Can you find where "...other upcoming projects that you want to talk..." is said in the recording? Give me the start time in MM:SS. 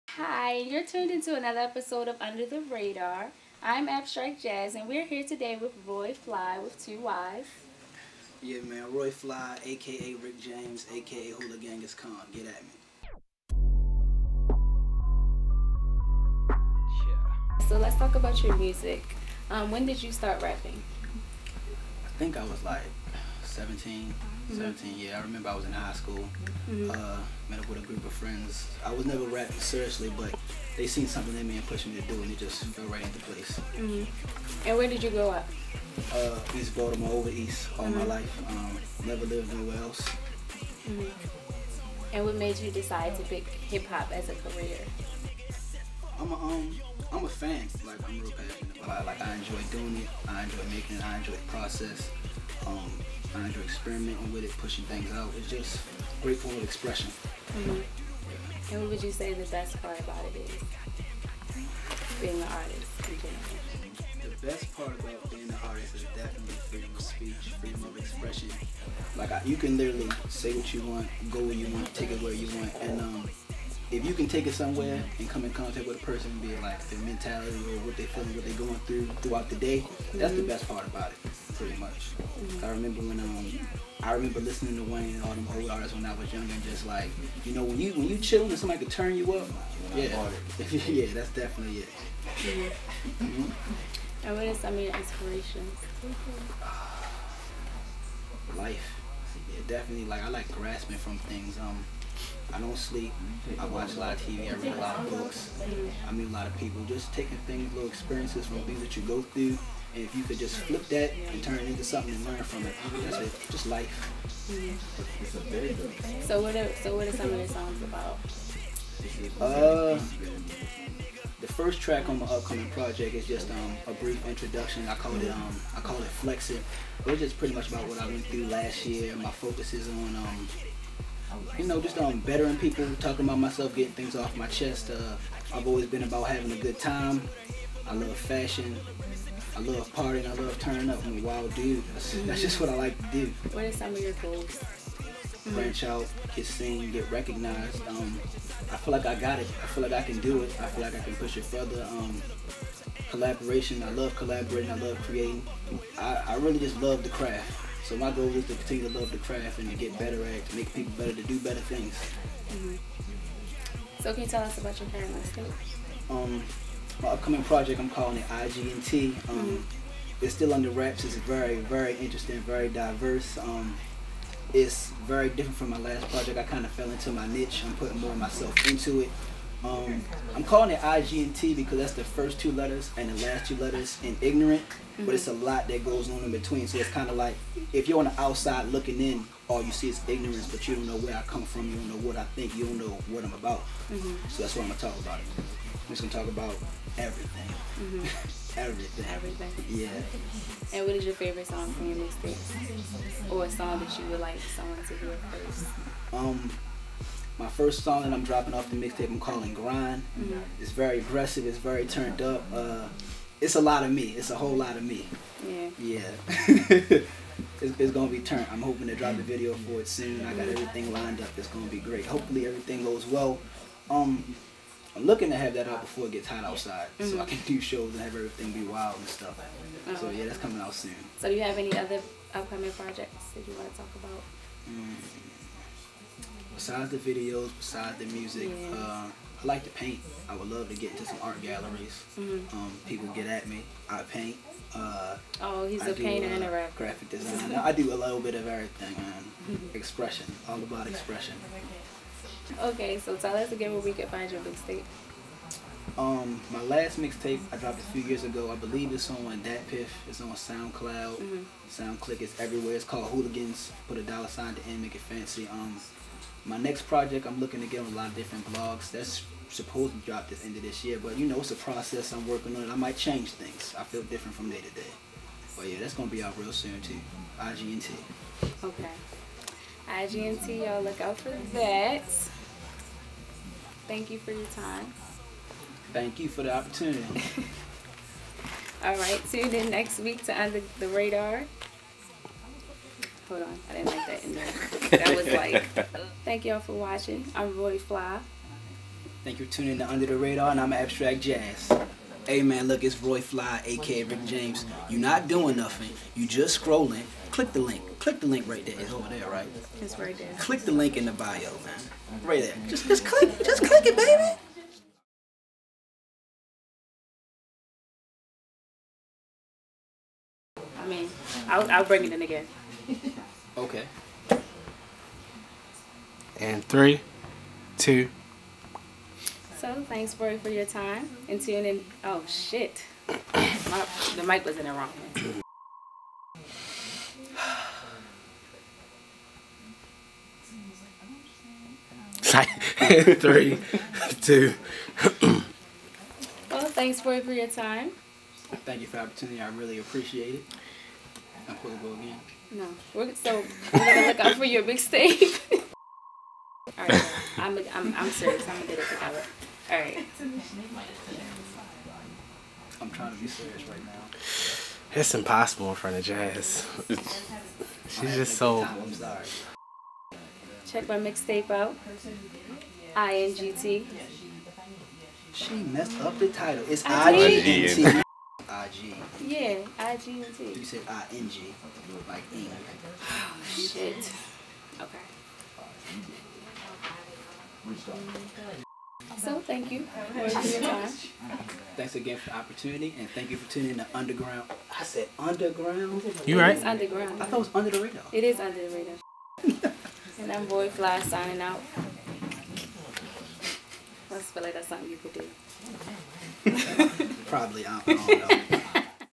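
03:51.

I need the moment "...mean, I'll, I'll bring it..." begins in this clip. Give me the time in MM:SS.
05:20.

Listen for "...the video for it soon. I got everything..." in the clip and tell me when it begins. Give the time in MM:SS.
03:39.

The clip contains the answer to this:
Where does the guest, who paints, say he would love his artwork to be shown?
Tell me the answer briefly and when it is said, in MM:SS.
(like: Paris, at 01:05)
art galleries, at 04:01.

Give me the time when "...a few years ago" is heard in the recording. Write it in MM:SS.
04:17.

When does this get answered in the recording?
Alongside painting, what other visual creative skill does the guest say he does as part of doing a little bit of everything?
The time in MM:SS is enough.
04:06.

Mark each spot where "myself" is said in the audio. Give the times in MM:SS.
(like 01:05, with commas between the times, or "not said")
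02:13, 02:58.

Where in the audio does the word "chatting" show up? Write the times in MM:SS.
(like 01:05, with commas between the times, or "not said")
not said.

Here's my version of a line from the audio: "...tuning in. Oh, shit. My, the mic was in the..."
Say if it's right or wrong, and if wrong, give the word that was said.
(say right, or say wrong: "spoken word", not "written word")
right.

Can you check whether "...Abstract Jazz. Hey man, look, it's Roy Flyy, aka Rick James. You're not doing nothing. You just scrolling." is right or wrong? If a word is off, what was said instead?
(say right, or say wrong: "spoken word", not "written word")
right.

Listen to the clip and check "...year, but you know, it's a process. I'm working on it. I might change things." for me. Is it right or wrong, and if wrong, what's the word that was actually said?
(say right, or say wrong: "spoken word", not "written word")
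right.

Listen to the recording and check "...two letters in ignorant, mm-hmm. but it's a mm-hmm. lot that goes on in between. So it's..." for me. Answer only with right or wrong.
right.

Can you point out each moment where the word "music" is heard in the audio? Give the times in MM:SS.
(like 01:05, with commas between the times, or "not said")
00:18, 03:58.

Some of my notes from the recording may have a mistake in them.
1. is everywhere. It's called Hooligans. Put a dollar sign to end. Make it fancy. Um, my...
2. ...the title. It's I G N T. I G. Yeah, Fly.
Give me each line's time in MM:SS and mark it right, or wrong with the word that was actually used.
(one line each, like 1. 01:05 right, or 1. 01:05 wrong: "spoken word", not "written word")
1. 04:22 right
2. 06:16 wrong: "IGNT", not "Fly".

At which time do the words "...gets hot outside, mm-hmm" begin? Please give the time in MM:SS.
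03:46.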